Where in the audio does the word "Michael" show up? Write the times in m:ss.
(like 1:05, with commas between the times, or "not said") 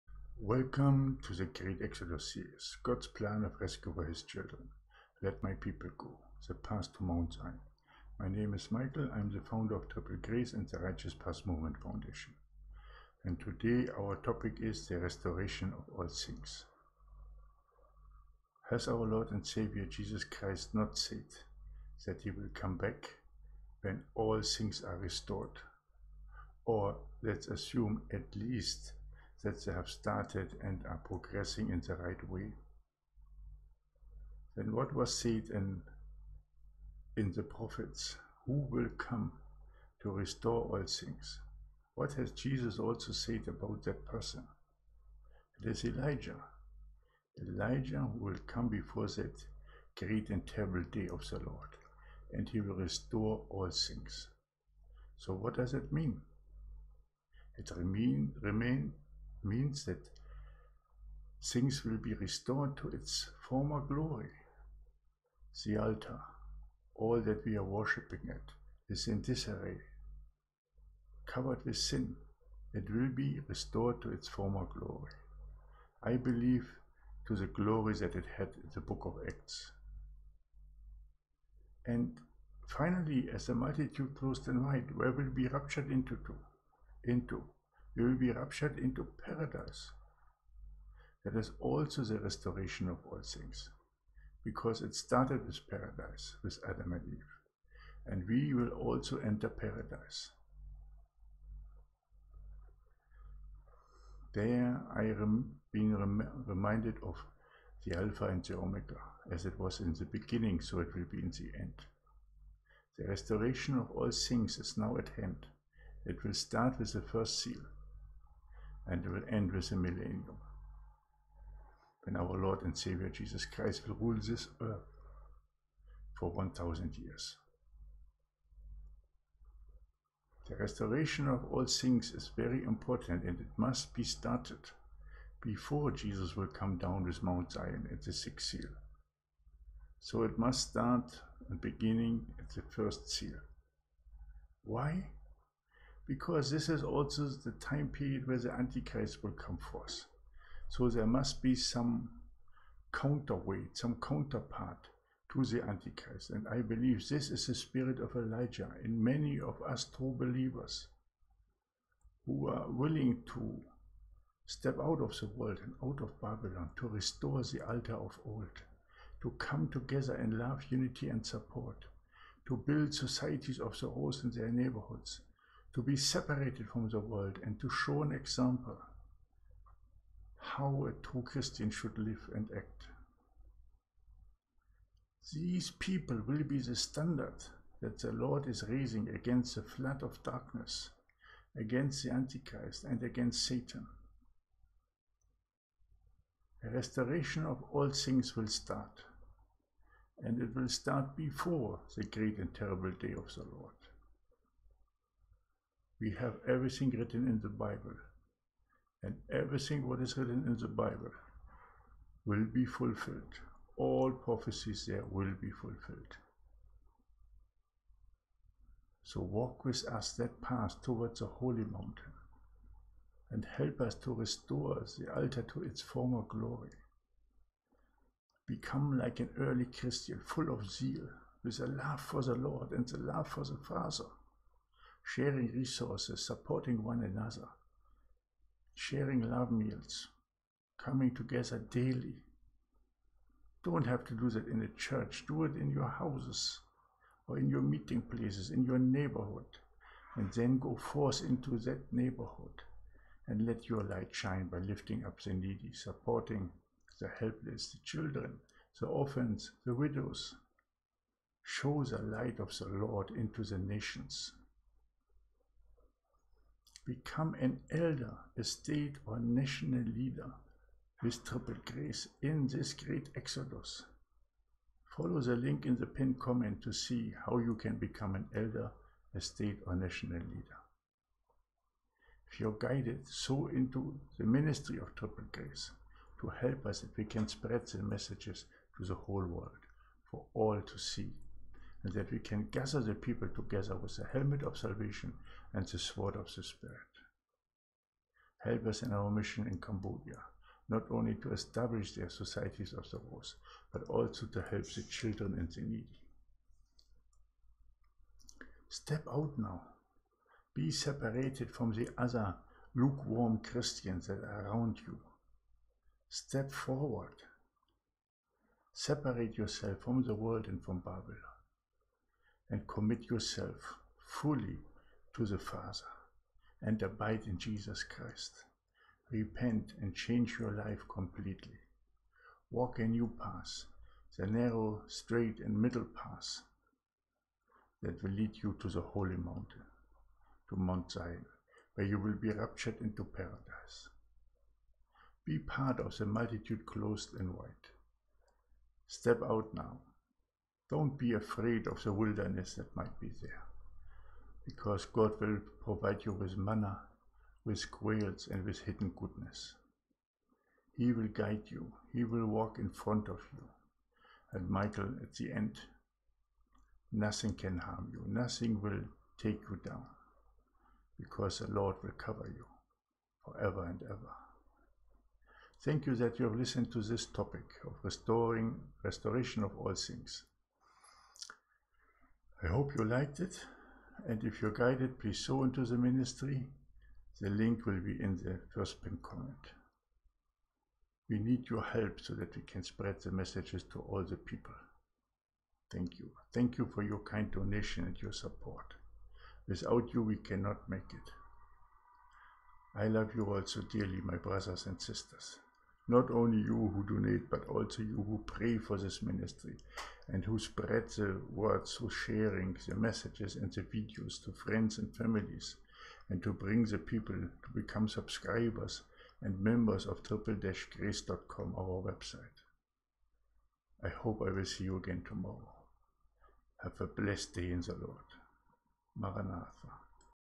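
0:08, 6:04.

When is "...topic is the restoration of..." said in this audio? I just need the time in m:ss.
0:14.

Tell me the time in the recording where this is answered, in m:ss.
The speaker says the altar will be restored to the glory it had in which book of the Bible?
1:18.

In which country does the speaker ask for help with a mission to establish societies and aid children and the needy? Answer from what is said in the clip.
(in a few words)
Cambodia.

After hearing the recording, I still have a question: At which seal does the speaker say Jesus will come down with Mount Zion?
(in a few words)
The sixth seal.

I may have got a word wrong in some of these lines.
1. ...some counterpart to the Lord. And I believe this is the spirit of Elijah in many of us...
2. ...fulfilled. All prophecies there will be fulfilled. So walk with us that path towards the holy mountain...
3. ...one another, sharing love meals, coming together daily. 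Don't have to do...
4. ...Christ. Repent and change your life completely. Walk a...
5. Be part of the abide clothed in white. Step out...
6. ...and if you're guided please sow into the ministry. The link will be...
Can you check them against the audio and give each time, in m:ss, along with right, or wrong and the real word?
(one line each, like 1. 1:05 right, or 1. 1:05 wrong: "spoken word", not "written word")
1. 2:33 wrong: "Antichrist", not "Lord"
2. 3:32 right
3. 3:56 right
4. 5:27 right
5. 5:45 wrong: "multitude", not "abide"
6. 6:24 right.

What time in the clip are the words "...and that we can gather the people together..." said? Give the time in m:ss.
4:51.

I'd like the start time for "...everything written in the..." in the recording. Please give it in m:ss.
3:26.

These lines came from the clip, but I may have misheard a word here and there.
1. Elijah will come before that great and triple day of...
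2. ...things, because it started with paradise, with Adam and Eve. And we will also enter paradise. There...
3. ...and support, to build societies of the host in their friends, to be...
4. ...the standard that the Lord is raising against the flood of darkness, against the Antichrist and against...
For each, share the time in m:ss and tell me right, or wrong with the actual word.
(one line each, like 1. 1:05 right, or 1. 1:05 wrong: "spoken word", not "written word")
1. 0:47 wrong: "terrible", not "triple"
2. 1:33 right
3. 2:51 wrong: "neighborhoods", not "friends"
4. 3:06 right.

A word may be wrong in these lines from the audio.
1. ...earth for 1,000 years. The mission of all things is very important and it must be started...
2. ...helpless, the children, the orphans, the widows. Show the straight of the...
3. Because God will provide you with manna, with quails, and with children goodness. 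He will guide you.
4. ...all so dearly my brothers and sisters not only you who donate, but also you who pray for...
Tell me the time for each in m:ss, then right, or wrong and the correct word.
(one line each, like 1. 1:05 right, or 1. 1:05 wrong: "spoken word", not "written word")
1. 2:04 wrong: "restoration", not "mission"
2. 4:17 wrong: "light", not "straight"
3. 5:54 wrong: "hidden", not "children"
4. 6:43 right.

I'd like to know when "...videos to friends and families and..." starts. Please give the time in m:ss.
6:53.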